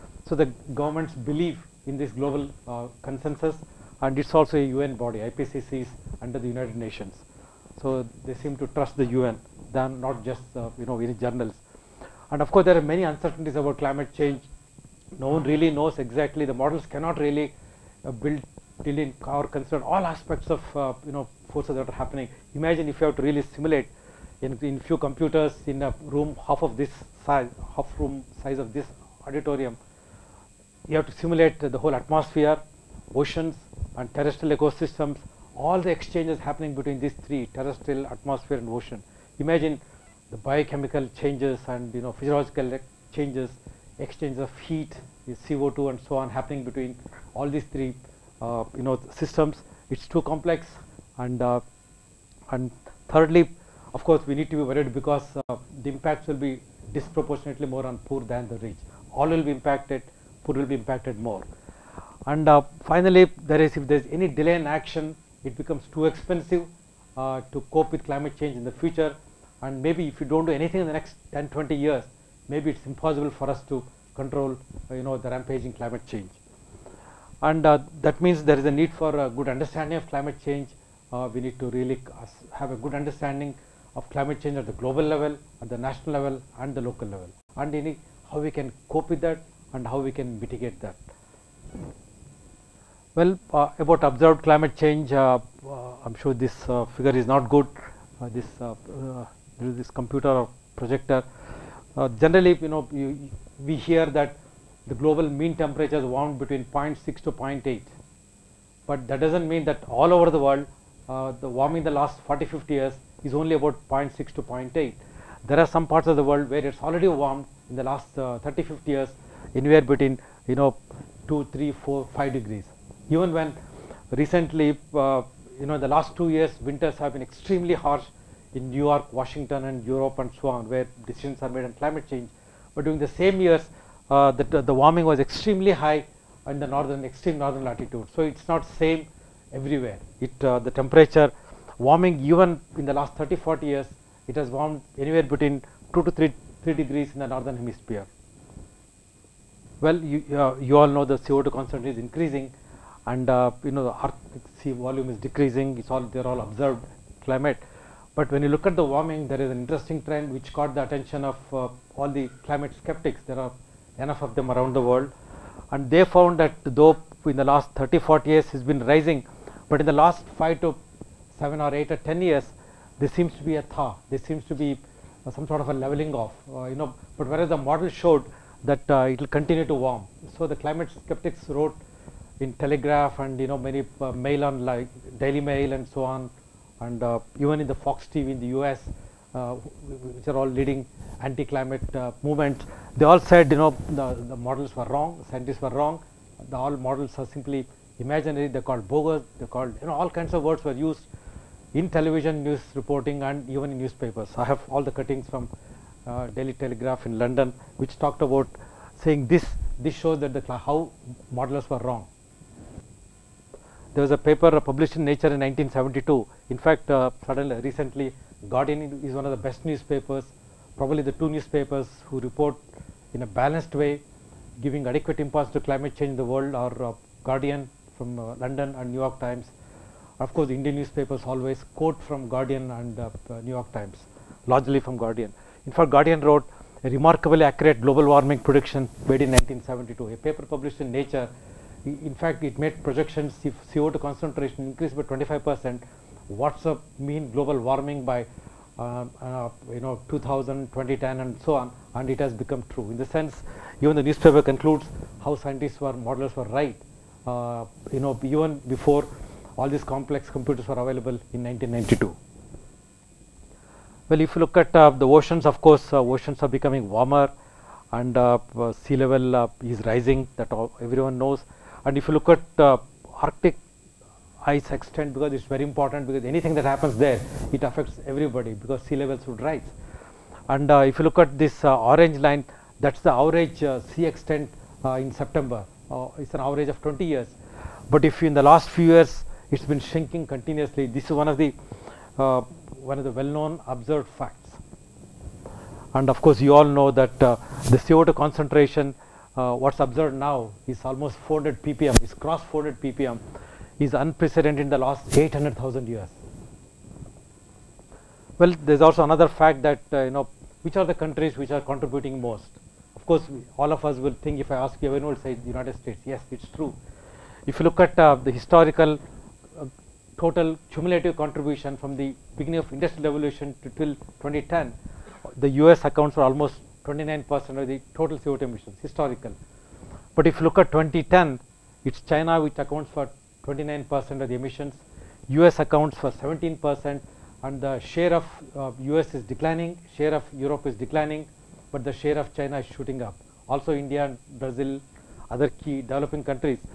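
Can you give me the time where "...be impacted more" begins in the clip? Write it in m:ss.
1:00.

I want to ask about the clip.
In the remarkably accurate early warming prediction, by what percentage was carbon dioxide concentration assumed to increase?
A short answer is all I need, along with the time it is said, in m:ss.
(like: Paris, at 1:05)
25 percent, at 4:05.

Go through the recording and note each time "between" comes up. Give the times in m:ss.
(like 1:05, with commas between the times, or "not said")
0:36, 0:46, 1:46, 1:59, 2:25.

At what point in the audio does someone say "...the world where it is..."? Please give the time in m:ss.
1:56.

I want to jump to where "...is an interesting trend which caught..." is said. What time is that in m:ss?
2:39.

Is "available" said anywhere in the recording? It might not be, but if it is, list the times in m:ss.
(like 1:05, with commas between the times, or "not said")
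4:20.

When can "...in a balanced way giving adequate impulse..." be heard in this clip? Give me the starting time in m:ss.
3:43.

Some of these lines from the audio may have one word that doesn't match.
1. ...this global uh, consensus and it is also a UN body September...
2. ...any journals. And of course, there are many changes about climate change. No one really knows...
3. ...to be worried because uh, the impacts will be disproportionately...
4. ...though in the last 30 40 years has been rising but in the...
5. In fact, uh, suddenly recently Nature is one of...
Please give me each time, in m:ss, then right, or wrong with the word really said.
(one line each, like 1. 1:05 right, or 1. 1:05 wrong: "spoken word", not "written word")
1. 0:01 wrong: "IPCC", not "September"
2. 0:10 wrong: "uncertainties", not "changes"
3. 0:54 right
4. 2:46 right
5. 3:36 wrong: "Guardian", not "Nature".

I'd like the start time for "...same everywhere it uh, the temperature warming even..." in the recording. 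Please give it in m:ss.
2:18.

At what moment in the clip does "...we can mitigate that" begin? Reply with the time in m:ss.
1:29.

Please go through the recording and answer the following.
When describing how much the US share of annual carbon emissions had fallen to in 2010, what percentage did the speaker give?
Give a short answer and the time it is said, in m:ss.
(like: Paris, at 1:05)
17 percent, at 5:36.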